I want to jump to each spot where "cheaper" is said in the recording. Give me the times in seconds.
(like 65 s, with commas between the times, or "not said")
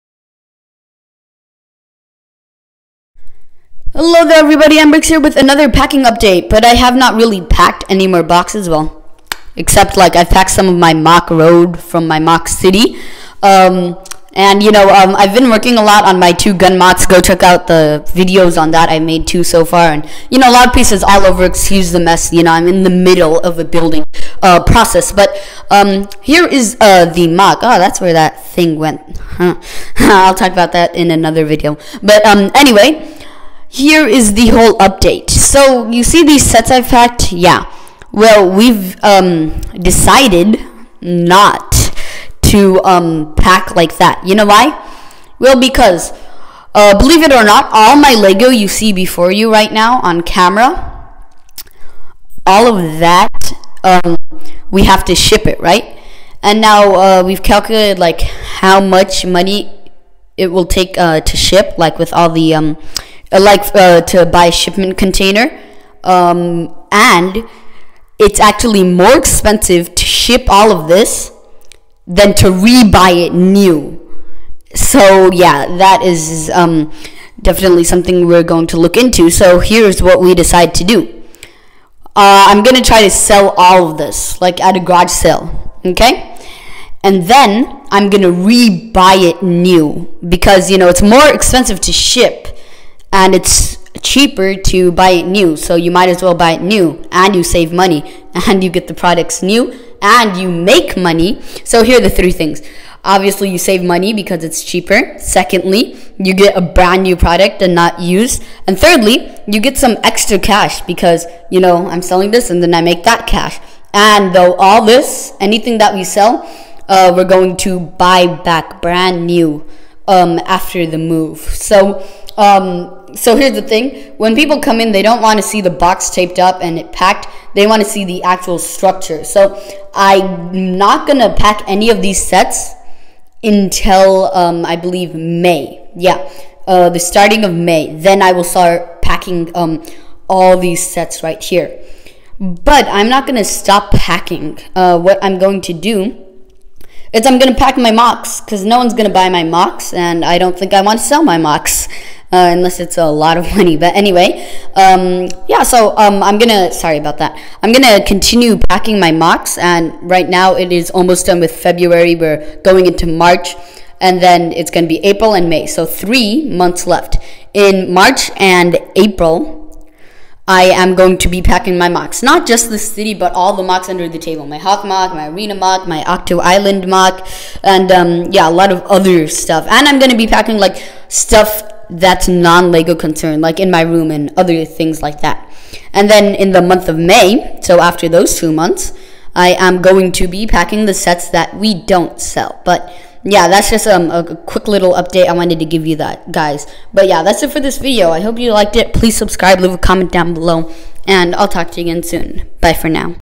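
94 s, 104 s.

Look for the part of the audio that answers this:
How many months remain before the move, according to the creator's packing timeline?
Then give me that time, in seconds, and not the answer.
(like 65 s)
165 s.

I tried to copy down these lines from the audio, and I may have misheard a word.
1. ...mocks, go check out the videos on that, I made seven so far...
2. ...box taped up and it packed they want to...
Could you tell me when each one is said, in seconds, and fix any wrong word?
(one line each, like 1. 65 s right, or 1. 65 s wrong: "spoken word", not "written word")
1. 16 s wrong: "two", not "seven"
2. 125 s right.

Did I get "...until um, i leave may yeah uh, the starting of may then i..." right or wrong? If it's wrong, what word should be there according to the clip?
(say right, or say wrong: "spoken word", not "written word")
wrong: "believe", not "leave".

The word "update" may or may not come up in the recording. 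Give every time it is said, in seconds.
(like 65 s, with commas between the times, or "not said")
6 s, 34 s, 194 s.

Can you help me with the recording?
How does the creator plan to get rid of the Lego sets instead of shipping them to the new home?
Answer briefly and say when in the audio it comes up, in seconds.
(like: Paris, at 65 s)
garage sale, at 84 s.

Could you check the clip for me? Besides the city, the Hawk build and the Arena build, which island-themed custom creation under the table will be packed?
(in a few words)
Octo Island.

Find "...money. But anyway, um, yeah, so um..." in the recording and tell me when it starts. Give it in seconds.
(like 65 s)
153 s.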